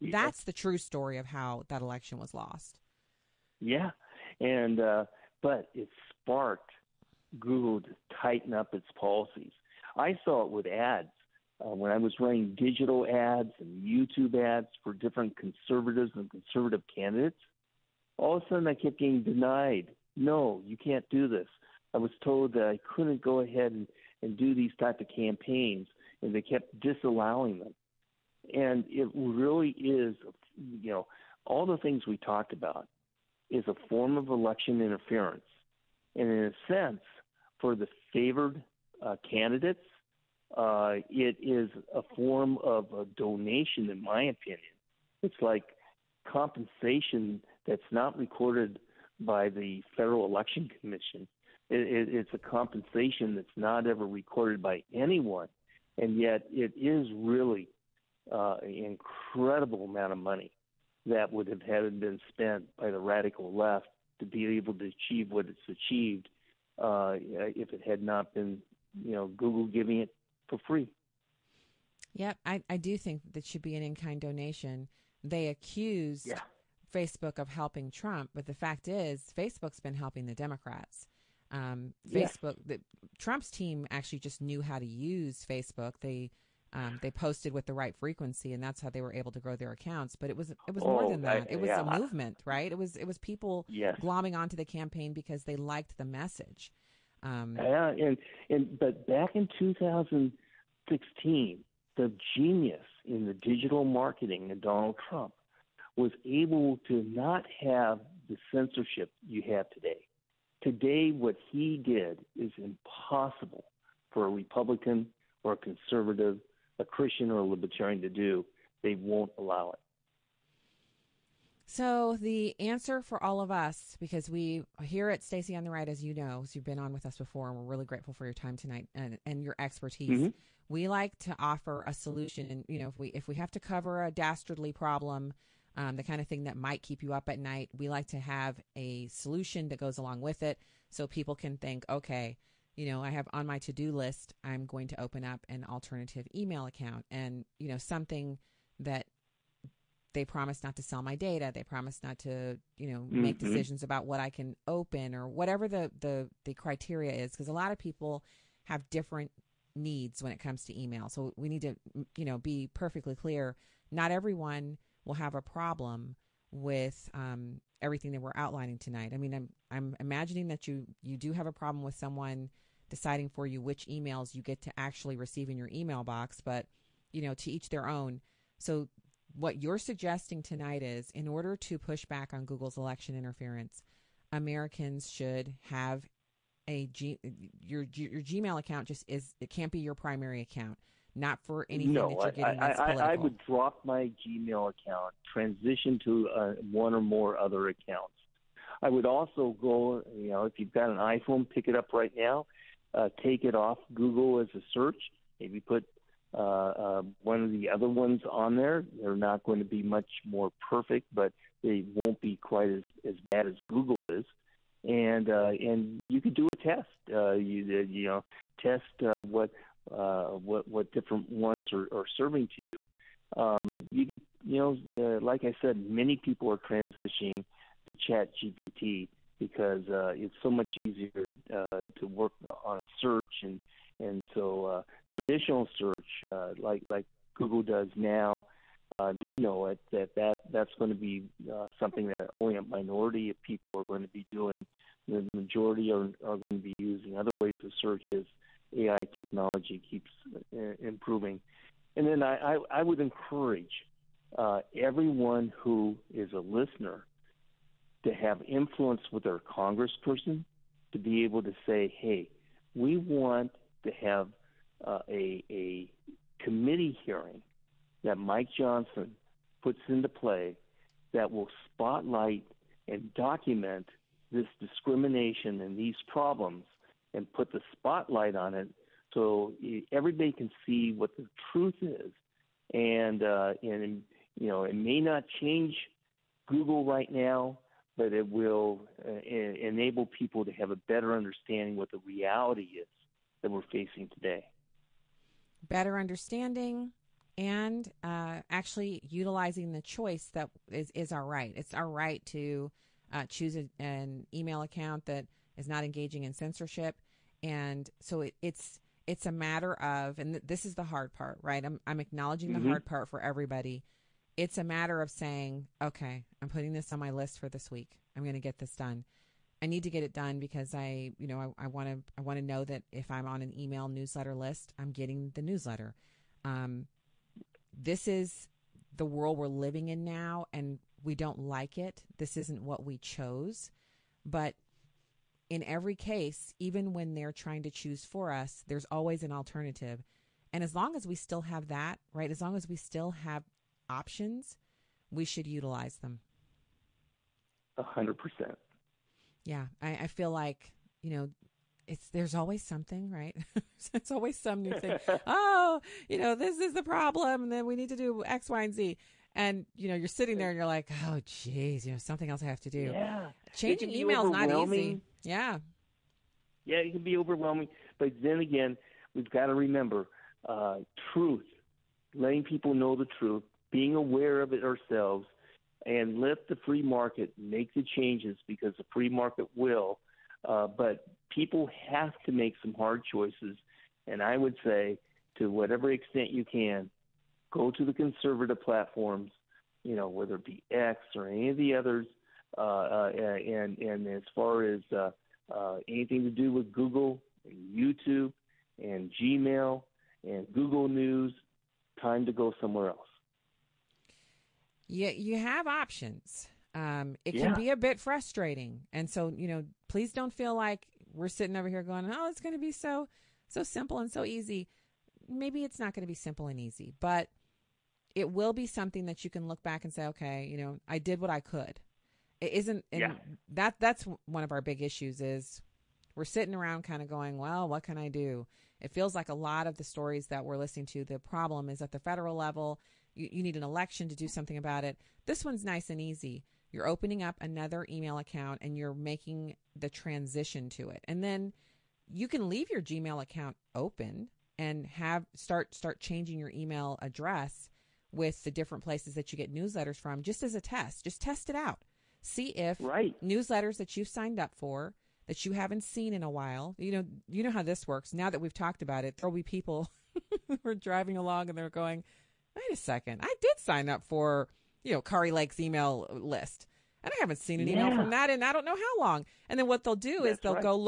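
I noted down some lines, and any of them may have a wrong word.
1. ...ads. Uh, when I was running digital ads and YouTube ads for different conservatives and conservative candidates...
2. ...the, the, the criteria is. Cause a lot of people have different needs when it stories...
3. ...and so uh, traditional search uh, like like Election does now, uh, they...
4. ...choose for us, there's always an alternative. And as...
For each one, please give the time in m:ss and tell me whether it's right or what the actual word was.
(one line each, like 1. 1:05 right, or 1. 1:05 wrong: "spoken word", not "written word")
1. 0:10 right
2. 2:35 wrong: "comes", not "stories"
3. 3:53 wrong: "Google", not "Election"
4. 5:37 right.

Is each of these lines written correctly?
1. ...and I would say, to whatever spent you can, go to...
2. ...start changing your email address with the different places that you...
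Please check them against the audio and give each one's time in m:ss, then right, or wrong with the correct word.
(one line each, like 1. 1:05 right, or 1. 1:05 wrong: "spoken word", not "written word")
1. 6:24 wrong: "extent", not "spent"
2. 7:25 right.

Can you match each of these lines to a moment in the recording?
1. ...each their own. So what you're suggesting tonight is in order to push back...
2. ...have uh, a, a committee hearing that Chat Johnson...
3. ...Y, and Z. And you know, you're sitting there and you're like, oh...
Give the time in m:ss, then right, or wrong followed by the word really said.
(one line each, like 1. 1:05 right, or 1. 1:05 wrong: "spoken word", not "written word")
1. 2:57 right
2. 4:24 wrong: "Mike", not "Chat"
3. 5:58 right.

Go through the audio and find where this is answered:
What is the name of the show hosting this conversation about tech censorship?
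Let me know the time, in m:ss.
2:05.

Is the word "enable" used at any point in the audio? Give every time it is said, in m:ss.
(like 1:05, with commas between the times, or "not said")
4:49.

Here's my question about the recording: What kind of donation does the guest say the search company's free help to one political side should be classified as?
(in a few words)
In kind donation.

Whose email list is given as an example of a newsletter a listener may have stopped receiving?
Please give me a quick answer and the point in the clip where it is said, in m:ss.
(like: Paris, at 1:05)
Kari Lake, at 7:45.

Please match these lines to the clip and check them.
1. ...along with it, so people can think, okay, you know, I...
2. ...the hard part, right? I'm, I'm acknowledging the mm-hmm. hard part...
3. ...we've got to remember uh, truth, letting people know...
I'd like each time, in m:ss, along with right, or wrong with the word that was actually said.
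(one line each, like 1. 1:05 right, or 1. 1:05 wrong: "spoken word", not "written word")
1. 2:19 right
2. 5:10 right
3. 6:09 right.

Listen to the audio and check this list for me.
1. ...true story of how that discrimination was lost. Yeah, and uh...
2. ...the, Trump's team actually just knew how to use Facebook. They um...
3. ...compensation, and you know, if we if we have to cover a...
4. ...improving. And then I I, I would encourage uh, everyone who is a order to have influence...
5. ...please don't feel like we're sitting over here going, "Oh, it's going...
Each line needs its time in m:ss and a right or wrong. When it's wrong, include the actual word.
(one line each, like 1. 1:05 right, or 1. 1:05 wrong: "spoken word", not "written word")
1. 0:00 wrong: "election", not "discrimination"
2. 1:22 right
3. 2:11 wrong: "solution", not "compensation"
4. 4:10 wrong: "listener", not "order"
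5. 6:49 right.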